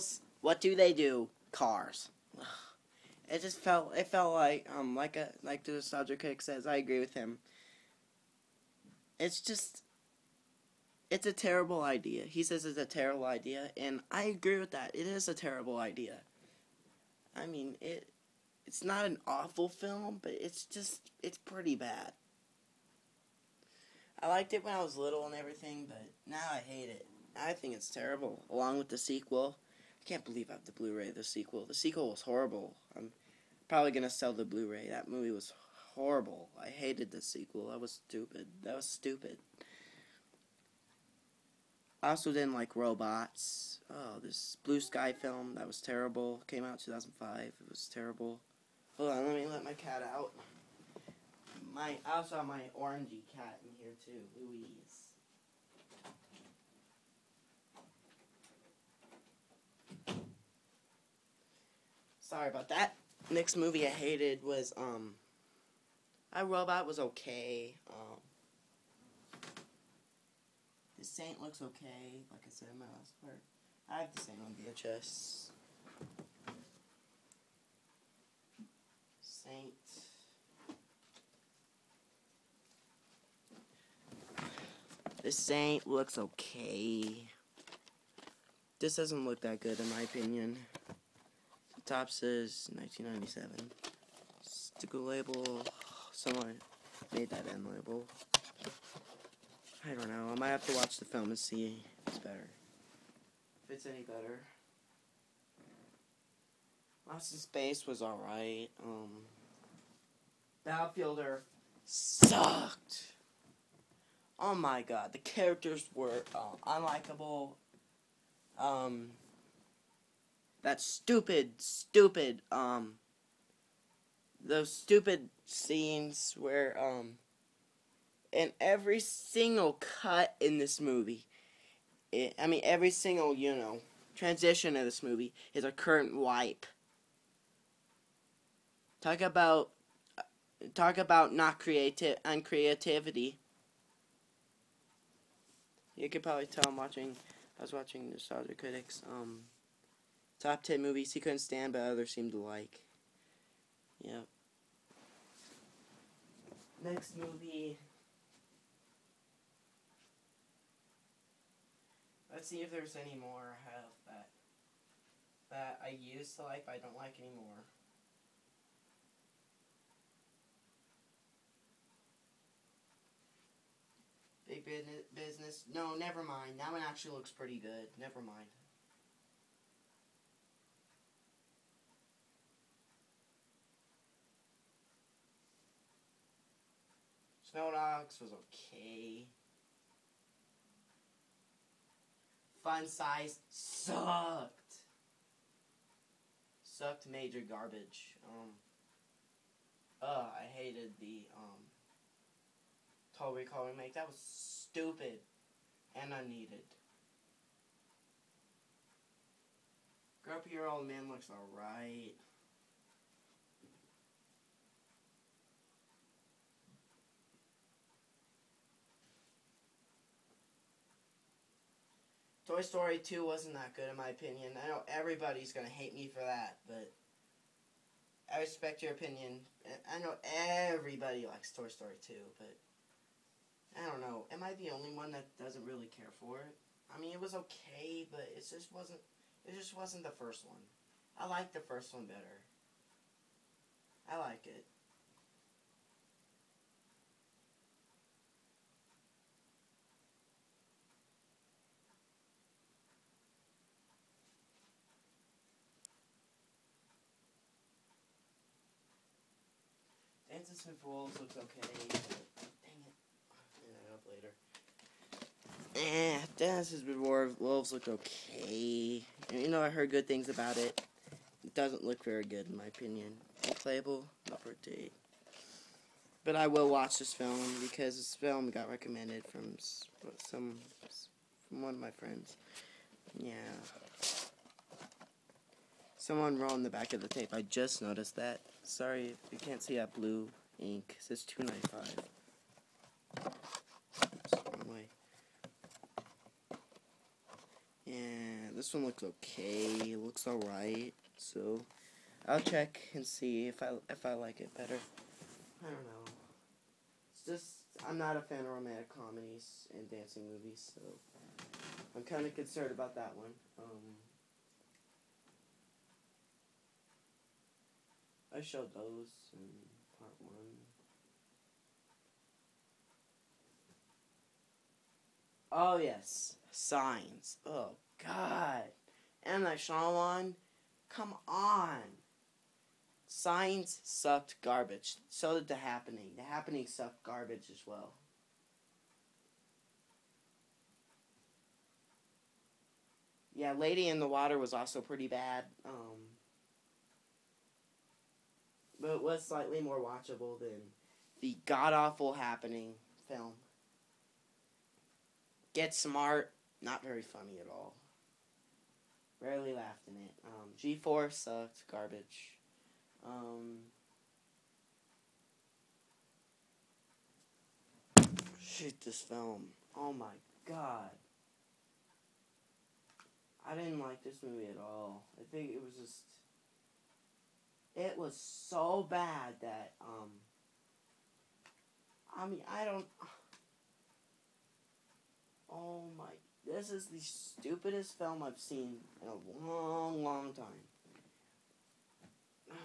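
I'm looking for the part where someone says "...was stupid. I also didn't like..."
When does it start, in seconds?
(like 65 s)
38 s.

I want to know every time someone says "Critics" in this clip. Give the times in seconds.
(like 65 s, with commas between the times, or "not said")
148 s.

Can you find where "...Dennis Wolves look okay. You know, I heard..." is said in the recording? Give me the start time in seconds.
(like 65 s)
266 s.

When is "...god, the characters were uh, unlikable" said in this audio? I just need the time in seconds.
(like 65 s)
114 s.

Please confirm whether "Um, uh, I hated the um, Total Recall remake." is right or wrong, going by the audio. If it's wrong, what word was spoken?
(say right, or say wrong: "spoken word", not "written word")
right.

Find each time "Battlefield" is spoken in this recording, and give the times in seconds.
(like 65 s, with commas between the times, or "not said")
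110 s.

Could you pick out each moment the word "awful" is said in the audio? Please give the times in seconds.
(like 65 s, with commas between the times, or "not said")
19 s, 351 s.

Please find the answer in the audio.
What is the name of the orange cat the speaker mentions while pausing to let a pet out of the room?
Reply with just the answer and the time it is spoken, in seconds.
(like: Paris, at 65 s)
Louise, at 54 s.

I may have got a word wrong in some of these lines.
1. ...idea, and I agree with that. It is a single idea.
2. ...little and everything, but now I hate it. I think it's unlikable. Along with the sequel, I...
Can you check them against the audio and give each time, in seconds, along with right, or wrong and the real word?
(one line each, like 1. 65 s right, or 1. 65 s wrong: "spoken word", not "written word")
1. 13 s wrong: "terrible", not "single"
2. 24 s wrong: "terrible", not "unlikable".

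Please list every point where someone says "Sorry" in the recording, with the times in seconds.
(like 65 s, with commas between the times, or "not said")
62 s, 288 s.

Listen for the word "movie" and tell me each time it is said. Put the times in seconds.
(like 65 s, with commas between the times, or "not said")
35 s, 63 s, 130 s, 135 s, 150 s, 157 s, 310 s, 374 s.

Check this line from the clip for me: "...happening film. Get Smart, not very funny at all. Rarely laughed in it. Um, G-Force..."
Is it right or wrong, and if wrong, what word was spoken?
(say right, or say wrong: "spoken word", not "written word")
right.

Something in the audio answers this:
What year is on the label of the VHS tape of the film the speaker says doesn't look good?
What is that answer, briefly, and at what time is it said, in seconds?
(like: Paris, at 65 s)
1997, at 92 s.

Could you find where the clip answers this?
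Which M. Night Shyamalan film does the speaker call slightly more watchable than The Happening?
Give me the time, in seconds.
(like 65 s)
343 s.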